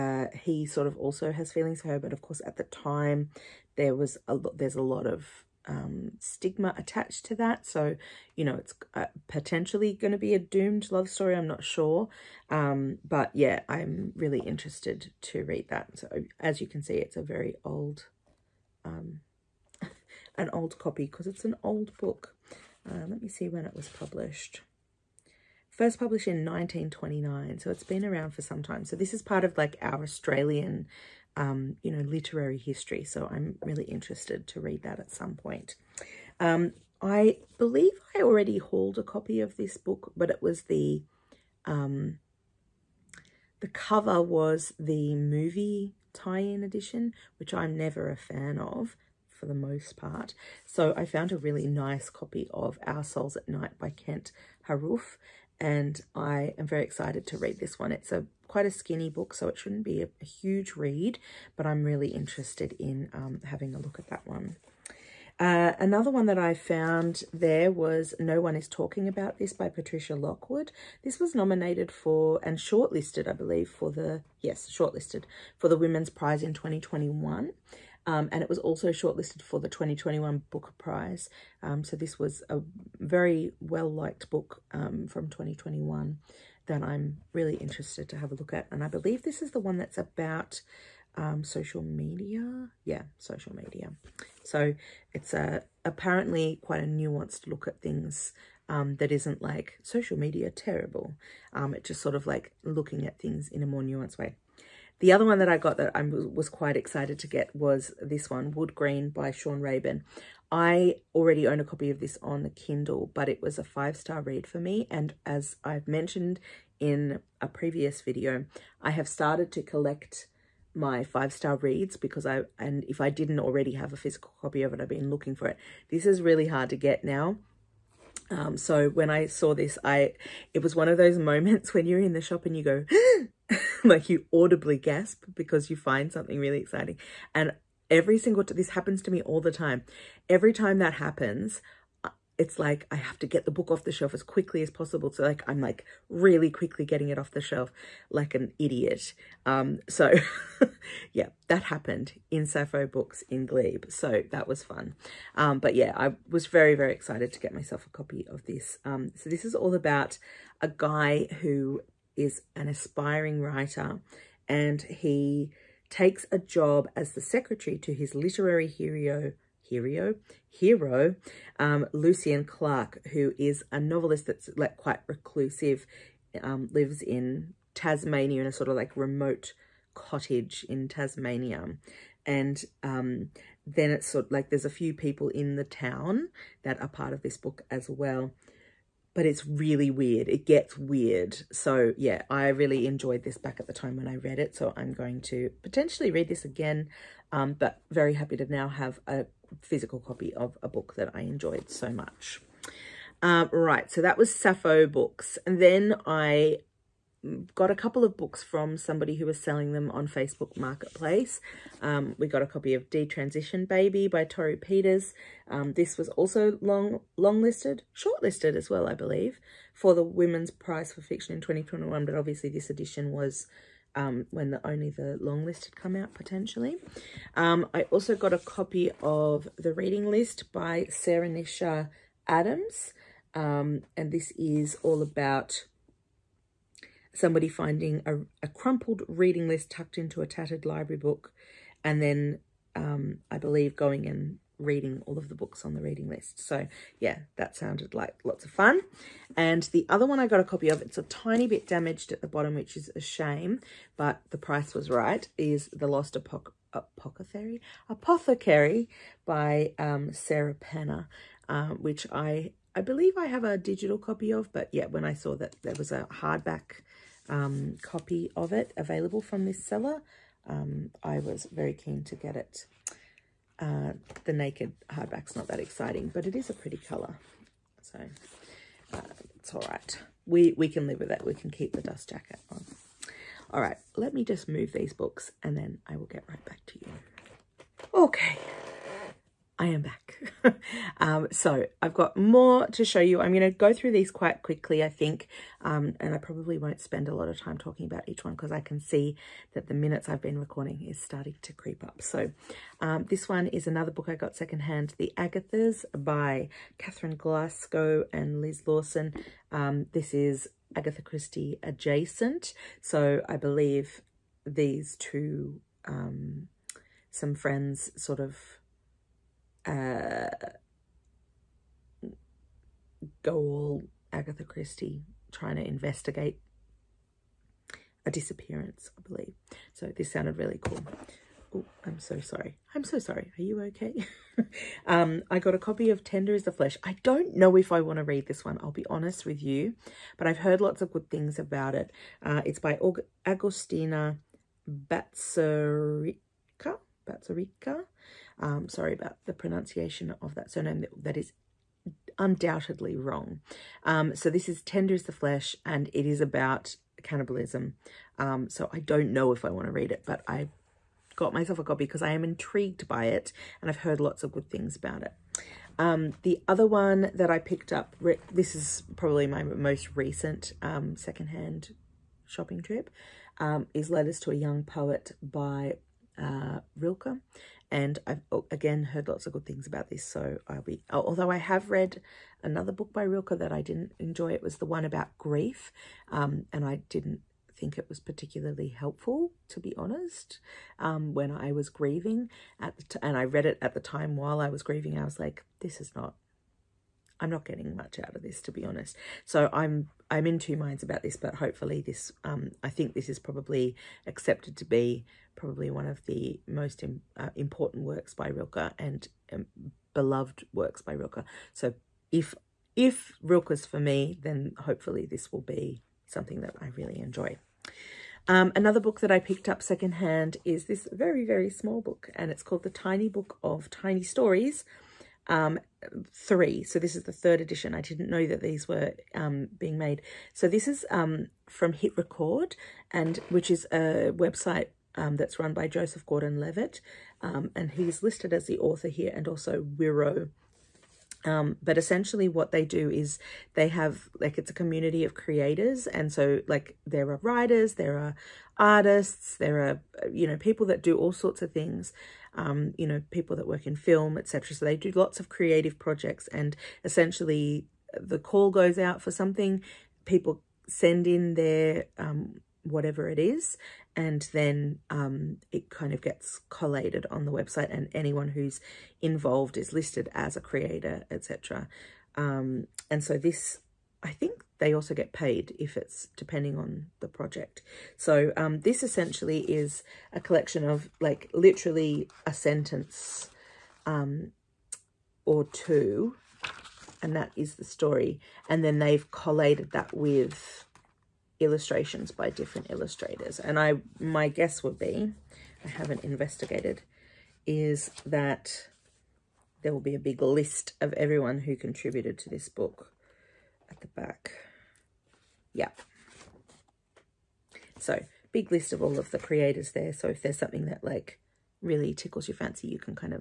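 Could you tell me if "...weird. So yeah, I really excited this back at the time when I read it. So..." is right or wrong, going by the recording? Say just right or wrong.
wrong.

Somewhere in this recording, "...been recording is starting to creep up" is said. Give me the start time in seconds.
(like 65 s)
300 s.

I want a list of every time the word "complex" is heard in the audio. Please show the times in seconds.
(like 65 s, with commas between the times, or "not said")
not said.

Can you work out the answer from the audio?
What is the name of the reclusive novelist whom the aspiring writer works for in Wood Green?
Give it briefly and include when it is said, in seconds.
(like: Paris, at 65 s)
Lucian Clark, at 171 s.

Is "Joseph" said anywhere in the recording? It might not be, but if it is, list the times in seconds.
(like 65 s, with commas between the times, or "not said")
435 s.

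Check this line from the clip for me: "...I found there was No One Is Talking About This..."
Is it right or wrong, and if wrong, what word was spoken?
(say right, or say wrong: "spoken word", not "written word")
right.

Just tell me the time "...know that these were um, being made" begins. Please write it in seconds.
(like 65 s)
428 s.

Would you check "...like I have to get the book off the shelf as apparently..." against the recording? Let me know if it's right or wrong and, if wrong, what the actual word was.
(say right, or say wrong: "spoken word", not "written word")
wrong: "quickly", not "apparently".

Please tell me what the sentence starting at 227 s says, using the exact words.
Um, I also got a copy of The Reading List by Sarah Nisha Adams.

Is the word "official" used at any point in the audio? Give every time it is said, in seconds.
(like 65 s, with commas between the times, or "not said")
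not said.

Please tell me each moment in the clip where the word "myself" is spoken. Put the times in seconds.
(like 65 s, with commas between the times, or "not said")
157 s, 361 s.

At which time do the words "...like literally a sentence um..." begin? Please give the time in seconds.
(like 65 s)
480 s.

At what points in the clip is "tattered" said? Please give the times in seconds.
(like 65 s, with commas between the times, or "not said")
240 s.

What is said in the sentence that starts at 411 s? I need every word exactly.
So if if Rilke's for me, then hopefully this will be something that I really enjoy.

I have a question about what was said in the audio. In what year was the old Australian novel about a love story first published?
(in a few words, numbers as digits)
1929.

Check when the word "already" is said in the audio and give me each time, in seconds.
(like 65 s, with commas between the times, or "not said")
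38 s, 111 s, 123 s.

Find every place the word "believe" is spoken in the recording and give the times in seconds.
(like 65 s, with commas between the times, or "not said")
37 s, 73 s, 88 s, 218 s, 243 s, 262 s, 313 s, 329 s.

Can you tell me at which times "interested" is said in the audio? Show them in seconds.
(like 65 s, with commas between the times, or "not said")
14 s, 33 s, 62 s, 87 s.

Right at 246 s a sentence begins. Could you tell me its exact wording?
So yeah, that sounded like lots of fun.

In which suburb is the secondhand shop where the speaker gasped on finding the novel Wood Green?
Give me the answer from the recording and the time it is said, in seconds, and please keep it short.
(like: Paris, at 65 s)
Glebe, at 153 s.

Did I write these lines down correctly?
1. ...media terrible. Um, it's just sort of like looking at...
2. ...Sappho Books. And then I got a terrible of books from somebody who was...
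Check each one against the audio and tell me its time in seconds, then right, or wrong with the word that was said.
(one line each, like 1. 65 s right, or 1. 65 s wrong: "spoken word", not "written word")
1. 100 s right
2. 204 s wrong: "couple", not "terrible".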